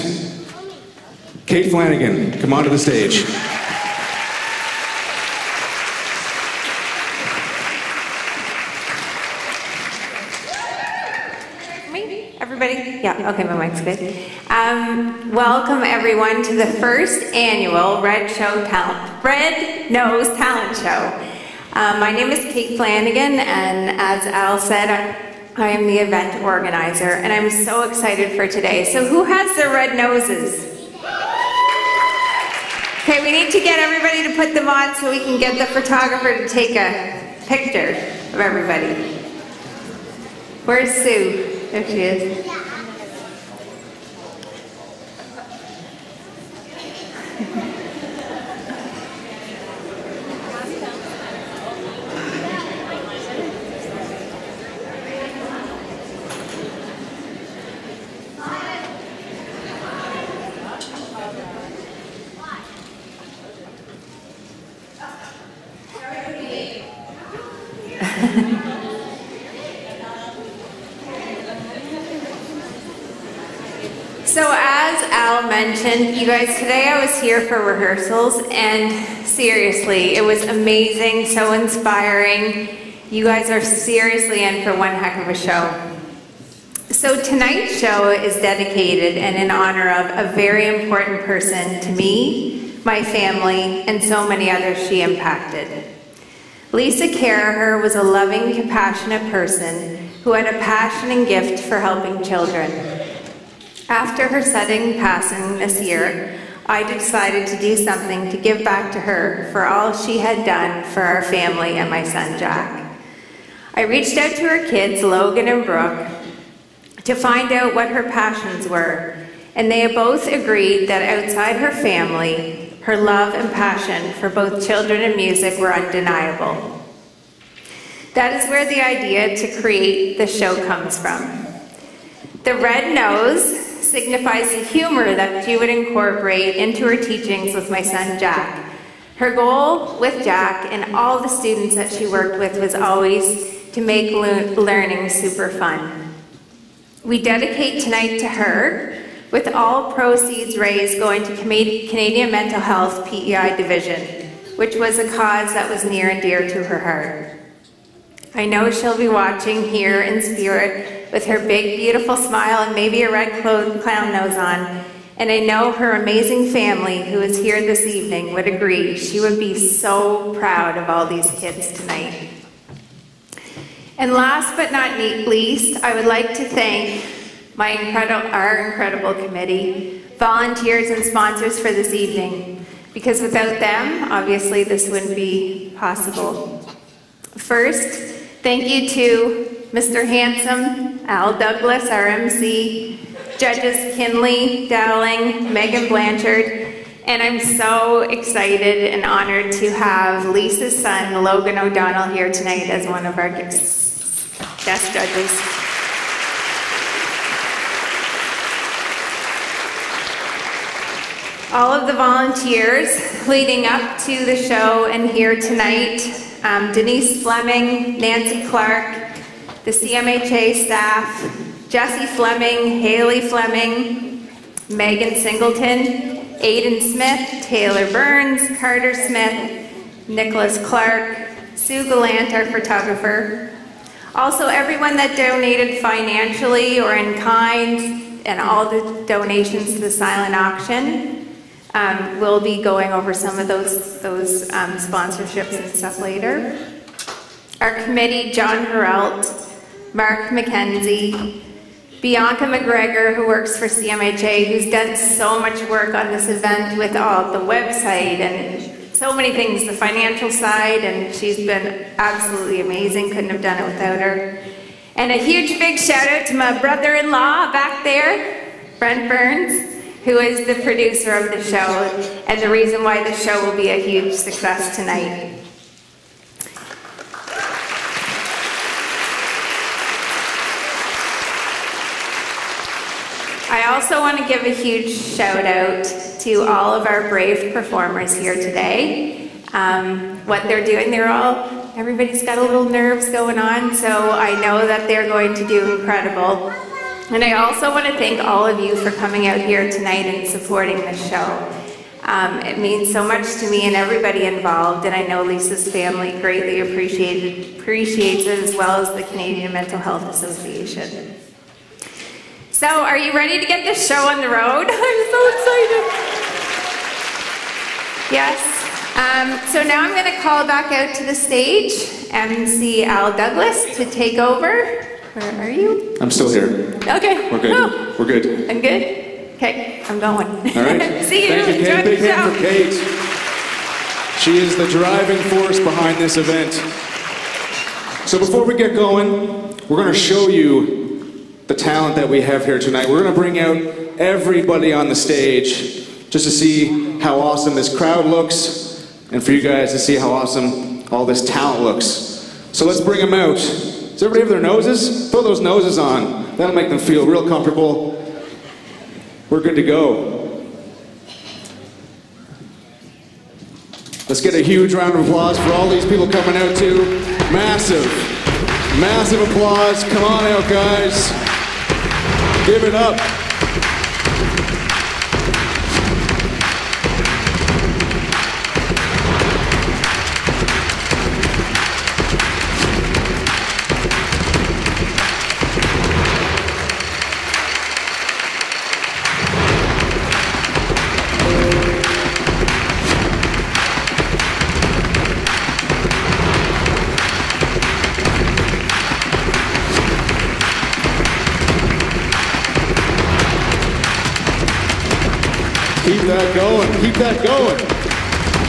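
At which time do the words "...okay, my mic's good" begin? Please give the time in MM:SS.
00:13.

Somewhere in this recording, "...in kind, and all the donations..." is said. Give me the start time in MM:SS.
03:56.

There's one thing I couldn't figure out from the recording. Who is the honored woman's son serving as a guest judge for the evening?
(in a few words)
Logan O'Donnell.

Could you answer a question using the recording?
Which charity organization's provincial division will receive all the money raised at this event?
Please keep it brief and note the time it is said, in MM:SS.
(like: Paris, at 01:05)
Canadian Mental Health PEI Division, at 02:31.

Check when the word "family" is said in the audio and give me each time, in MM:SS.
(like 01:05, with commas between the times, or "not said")
01:33, 01:51, 02:01, 02:46, 05:05.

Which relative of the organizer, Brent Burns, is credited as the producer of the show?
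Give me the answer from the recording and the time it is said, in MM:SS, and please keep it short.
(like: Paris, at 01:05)
brother-in-law, at 04:26.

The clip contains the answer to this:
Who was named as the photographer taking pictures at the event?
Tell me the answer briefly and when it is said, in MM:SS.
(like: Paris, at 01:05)
Sue Gallant, at 03:51.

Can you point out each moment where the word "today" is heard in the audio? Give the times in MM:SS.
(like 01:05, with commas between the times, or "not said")
00:28, 01:16, 04:48.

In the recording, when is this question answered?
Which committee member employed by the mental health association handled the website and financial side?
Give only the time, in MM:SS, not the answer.
04:12.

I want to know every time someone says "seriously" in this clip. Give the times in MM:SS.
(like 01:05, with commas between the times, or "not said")
01:19, 01:23.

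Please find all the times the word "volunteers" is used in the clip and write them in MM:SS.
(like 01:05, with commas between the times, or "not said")
03:00, 03:31.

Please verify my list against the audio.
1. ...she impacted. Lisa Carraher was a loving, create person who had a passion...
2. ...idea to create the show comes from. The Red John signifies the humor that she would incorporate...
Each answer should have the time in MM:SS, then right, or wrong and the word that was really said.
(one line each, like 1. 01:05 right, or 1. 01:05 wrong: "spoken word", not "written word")
1. 01:34 wrong: "compassionate", not "create"
2. 02:08 wrong: "Nose", not "John".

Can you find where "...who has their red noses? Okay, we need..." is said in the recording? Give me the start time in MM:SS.
00:29.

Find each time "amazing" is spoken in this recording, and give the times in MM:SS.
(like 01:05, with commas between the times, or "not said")
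01:20, 02:46, 04:22.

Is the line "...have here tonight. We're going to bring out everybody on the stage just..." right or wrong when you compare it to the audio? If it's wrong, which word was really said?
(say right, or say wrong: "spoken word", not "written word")
right.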